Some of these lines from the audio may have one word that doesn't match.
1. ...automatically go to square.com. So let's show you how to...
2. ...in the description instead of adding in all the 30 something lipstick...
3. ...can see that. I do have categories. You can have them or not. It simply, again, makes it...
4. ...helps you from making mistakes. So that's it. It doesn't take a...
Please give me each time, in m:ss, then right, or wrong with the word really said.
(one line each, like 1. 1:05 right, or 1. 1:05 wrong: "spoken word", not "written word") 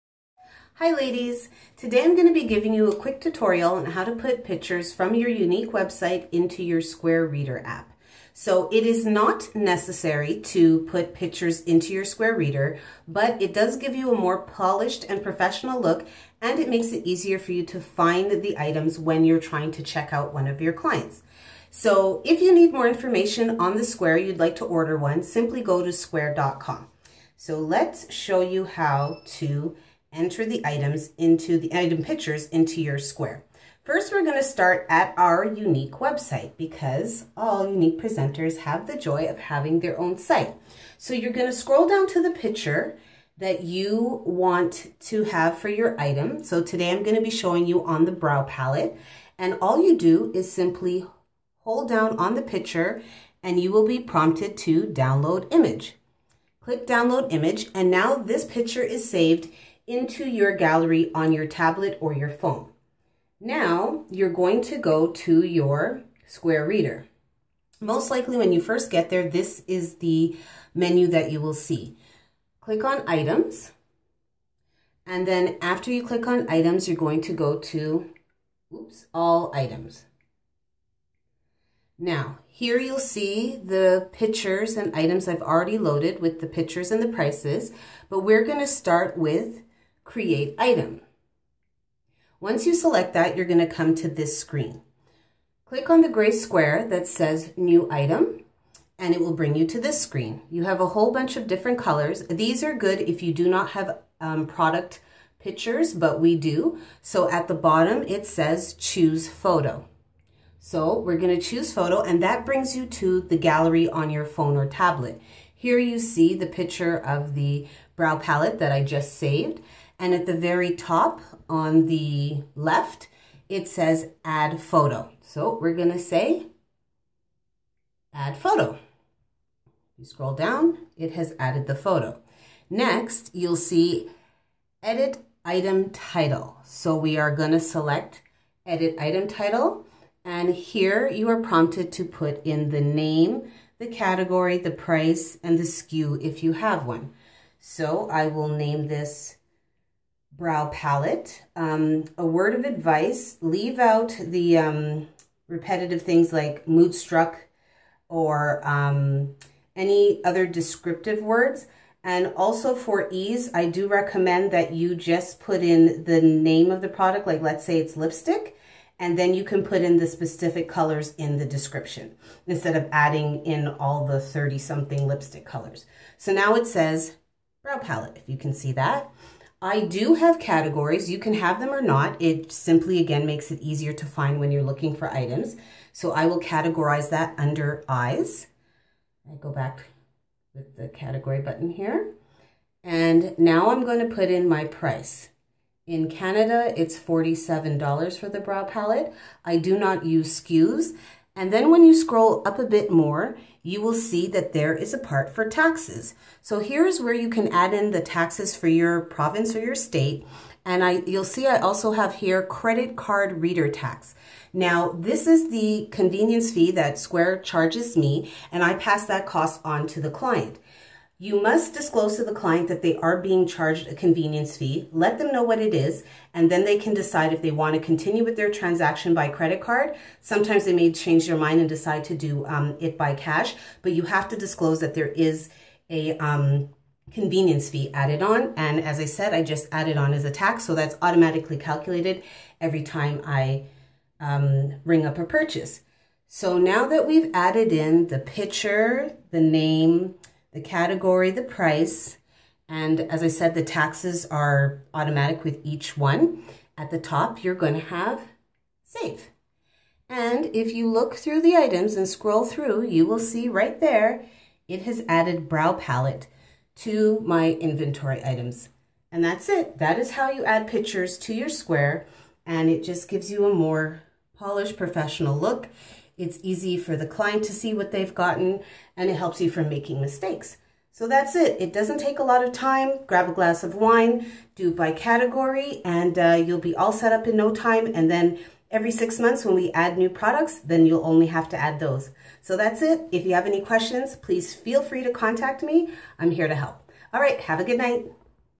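1. 0:25 wrong: "simply", not "automatically"
2. 2:51 right
3. 2:58 right
4. 4:39 right.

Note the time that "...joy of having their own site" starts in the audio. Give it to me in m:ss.
0:38.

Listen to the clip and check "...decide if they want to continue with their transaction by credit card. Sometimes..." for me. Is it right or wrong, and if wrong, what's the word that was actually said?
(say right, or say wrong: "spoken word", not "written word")
right.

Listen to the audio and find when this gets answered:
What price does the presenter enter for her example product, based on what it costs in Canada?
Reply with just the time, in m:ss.
3:16.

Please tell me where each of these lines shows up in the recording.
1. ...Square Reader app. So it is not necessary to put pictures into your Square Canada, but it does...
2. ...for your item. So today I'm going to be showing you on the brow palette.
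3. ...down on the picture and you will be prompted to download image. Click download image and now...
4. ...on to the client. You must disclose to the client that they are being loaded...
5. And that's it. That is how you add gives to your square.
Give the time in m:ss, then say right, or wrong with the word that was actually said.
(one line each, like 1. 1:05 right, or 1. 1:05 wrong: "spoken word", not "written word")
1. 0:06 wrong: "Reader", not "Canada"
2. 0:45 right
3. 0:51 right
4. 3:39 wrong: "charged", not "loaded"
5. 4:29 wrong: "pictures", not "gives".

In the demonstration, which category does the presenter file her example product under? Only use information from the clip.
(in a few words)
eyes.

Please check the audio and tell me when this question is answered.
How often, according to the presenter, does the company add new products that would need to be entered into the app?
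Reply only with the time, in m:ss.
4:48.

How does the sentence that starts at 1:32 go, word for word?
Once you select that, you're gonna come to this screen.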